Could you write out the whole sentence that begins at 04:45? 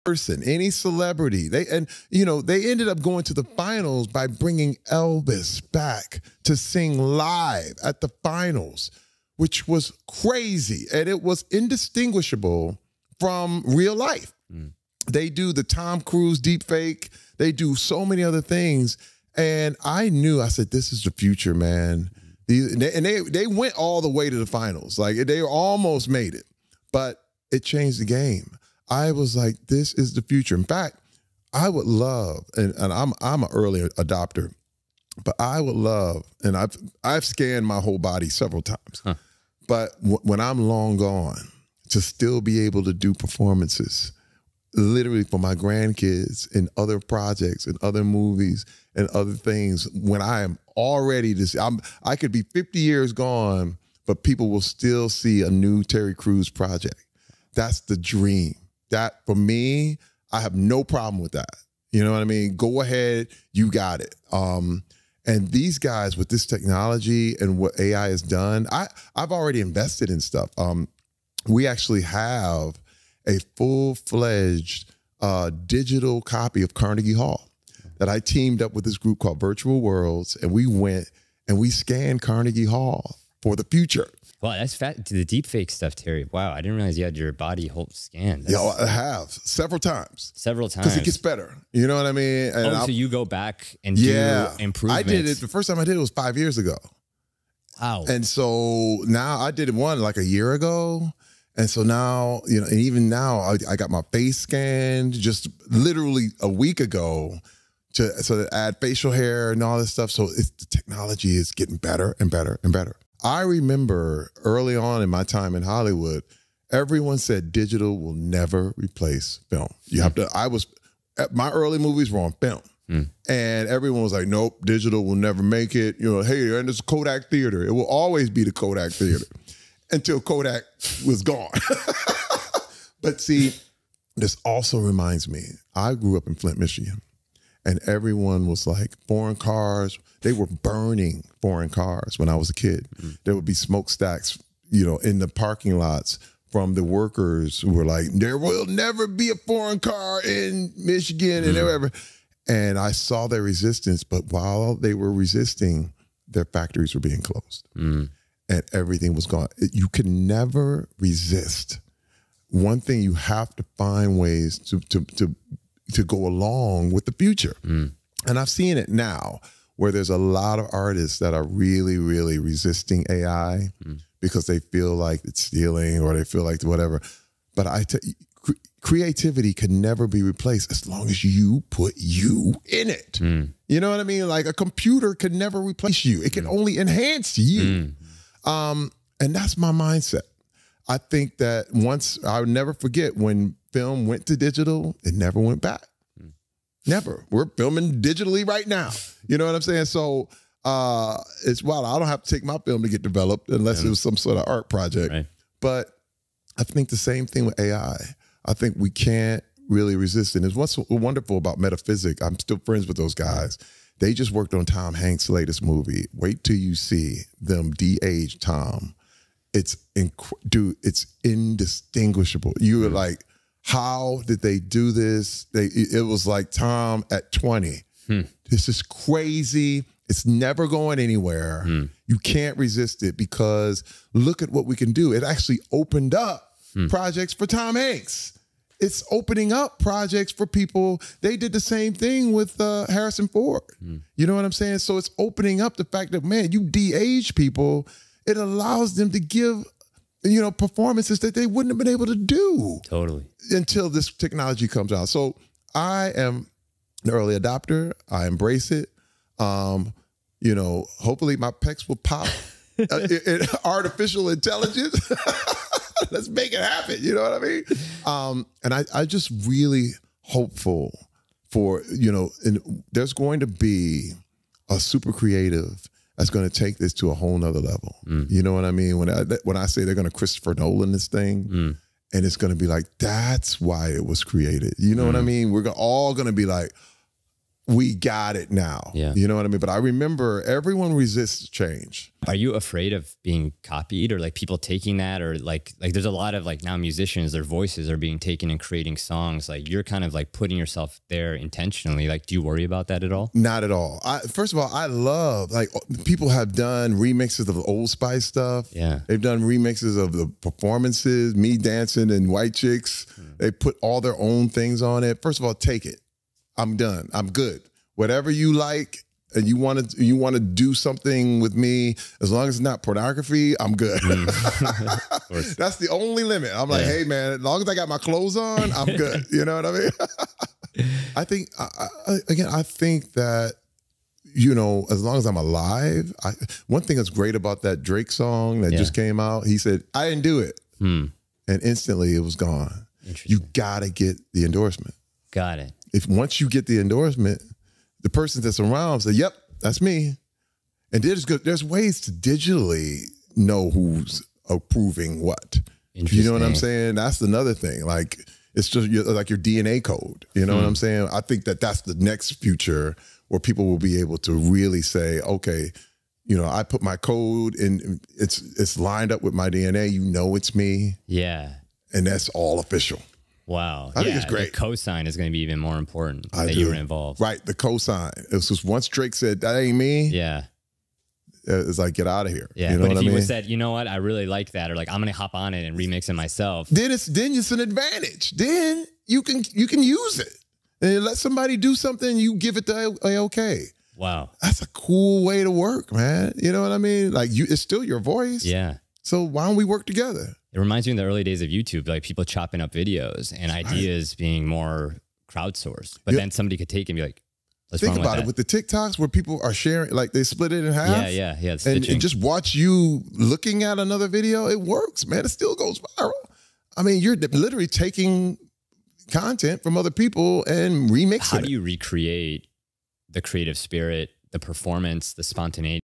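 We're all going to be like, we got it now.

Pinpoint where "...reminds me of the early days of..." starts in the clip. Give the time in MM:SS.
06:40.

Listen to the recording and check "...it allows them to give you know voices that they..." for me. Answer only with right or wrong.
wrong.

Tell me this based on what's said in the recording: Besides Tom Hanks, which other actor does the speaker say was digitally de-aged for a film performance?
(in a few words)
Harrison Ford.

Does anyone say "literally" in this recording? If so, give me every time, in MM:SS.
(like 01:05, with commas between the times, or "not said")
00:44, 01:45, 06:57.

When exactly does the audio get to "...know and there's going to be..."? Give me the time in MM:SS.
04:32.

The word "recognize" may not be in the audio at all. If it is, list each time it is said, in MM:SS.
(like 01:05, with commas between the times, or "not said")
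not said.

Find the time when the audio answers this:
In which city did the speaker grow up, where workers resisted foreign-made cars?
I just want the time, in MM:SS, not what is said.
02:16.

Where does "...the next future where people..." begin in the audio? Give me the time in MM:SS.
06:01.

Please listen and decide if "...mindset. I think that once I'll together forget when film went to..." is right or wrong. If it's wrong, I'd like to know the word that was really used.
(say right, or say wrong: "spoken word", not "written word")
wrong: "never", not "together".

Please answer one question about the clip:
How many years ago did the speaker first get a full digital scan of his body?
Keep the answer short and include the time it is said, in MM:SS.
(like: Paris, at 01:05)
5, at 01:36.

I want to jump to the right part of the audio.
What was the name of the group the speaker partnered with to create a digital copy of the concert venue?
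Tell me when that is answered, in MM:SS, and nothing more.
01:19.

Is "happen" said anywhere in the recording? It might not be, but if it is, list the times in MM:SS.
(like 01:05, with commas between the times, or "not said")
04:26.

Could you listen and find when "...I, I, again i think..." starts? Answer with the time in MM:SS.
05:31.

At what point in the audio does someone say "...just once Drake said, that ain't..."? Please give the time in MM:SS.
06:18.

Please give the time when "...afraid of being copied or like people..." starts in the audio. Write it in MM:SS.
04:52.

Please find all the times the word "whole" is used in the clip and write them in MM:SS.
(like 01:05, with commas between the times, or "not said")
00:37, 01:27, 04:37.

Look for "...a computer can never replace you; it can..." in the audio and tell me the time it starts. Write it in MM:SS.
03:04.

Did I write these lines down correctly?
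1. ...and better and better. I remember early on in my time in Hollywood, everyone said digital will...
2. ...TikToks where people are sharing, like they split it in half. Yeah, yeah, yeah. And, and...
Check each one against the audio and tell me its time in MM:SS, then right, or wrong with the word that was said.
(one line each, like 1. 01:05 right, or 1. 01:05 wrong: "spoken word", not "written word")
1. 01:52 right
2. 06:48 right.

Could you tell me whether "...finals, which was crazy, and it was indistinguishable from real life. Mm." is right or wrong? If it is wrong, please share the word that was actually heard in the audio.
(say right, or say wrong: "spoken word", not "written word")
right.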